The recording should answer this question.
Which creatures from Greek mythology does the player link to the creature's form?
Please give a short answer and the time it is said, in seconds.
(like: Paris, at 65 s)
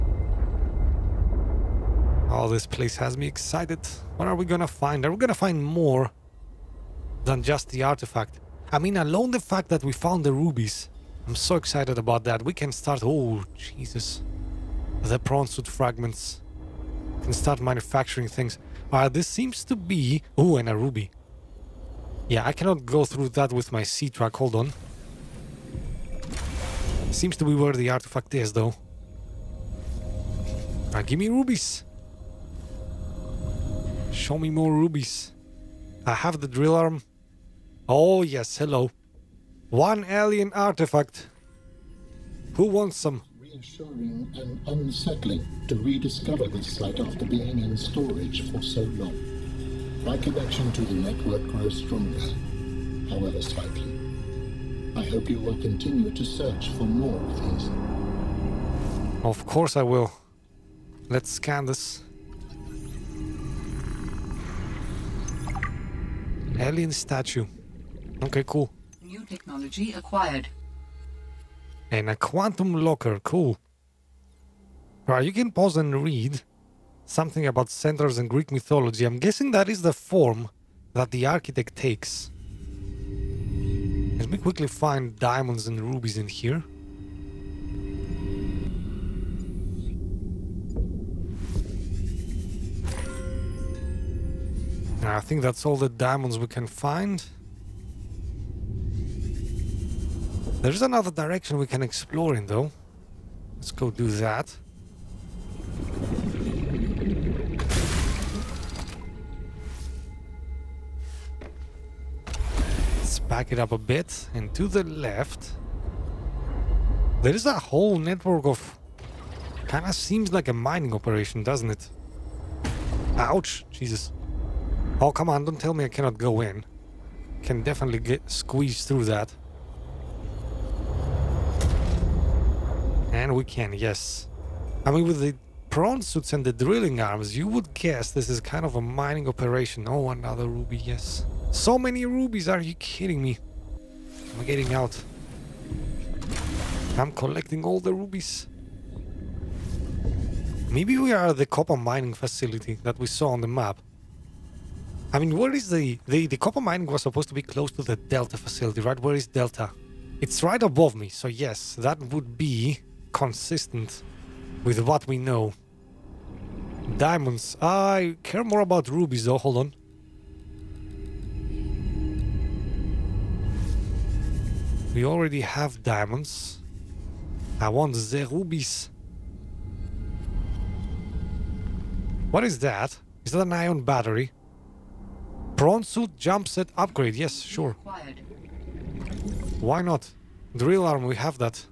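Centaurs, at 77 s.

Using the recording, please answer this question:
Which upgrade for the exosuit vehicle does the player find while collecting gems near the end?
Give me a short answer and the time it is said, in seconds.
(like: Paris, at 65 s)
Prawn suit jump jet upgrade, at 185 s.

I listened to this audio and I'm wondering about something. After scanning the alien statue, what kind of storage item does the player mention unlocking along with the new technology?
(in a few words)
Quantum locker.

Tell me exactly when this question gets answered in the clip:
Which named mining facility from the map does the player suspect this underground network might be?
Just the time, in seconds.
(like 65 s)
151 s.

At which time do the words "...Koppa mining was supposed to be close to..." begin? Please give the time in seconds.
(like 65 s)
156 s.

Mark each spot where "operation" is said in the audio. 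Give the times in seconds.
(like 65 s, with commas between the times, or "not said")
120 s, 139 s.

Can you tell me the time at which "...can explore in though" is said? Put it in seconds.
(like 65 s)
101 s.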